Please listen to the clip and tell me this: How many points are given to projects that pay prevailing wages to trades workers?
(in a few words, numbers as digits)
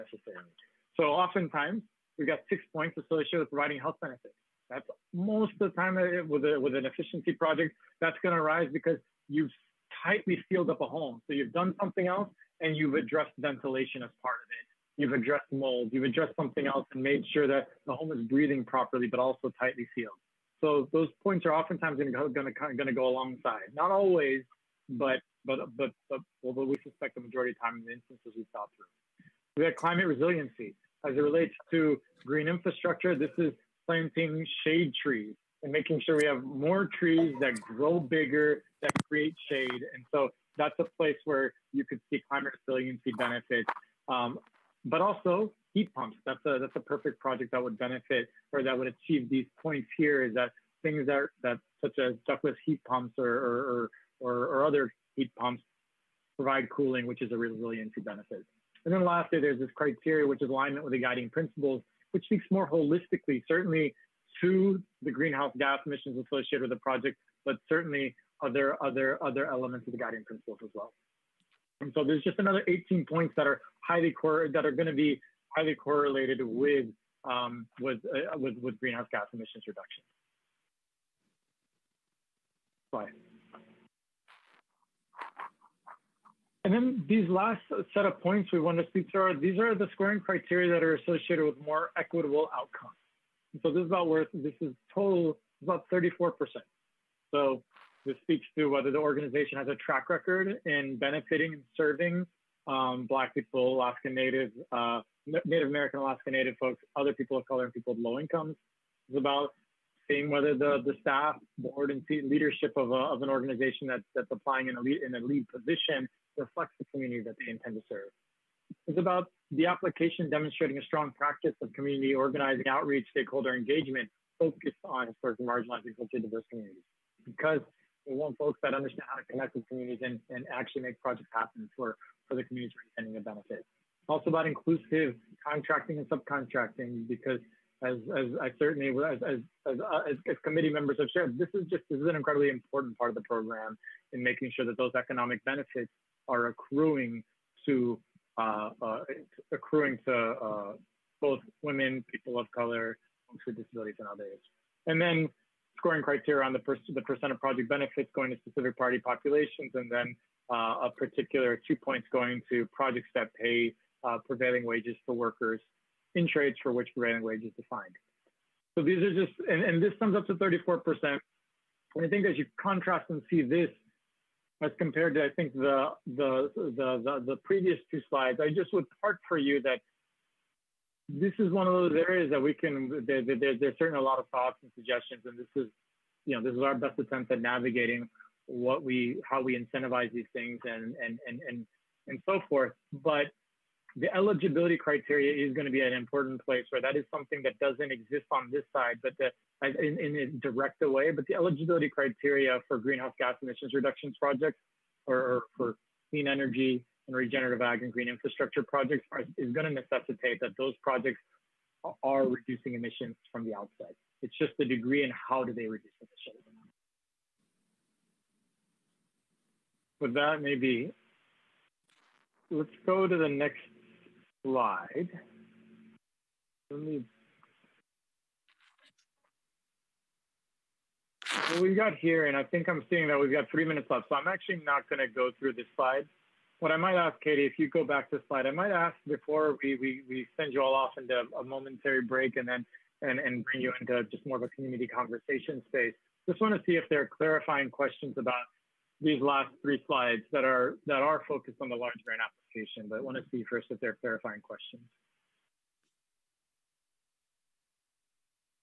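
2.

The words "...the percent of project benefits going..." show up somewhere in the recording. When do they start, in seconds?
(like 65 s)
156 s.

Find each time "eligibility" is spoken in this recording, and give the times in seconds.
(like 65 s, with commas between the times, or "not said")
194 s, 201 s.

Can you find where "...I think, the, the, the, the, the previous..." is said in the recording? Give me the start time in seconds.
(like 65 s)
175 s.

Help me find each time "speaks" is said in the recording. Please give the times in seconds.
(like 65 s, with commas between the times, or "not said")
62 s, 88 s, 98 s.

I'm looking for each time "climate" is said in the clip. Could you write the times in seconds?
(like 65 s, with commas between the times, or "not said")
29 s, 42 s.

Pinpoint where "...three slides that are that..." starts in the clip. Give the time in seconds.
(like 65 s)
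249 s.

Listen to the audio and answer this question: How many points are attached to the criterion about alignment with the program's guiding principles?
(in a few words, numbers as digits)
18.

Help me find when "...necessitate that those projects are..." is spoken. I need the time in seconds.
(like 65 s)
209 s.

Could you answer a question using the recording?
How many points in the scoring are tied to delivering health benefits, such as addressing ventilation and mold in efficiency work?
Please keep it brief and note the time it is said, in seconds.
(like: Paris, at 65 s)
6, at 2 s.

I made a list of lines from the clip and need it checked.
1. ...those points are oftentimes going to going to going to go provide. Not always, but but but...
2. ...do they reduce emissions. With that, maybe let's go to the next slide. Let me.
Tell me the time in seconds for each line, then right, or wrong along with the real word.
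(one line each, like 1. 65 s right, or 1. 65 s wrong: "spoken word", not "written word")
1. 20 s wrong: "alongside", not "provide"
2. 215 s right.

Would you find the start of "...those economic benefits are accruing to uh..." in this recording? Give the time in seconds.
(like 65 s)
144 s.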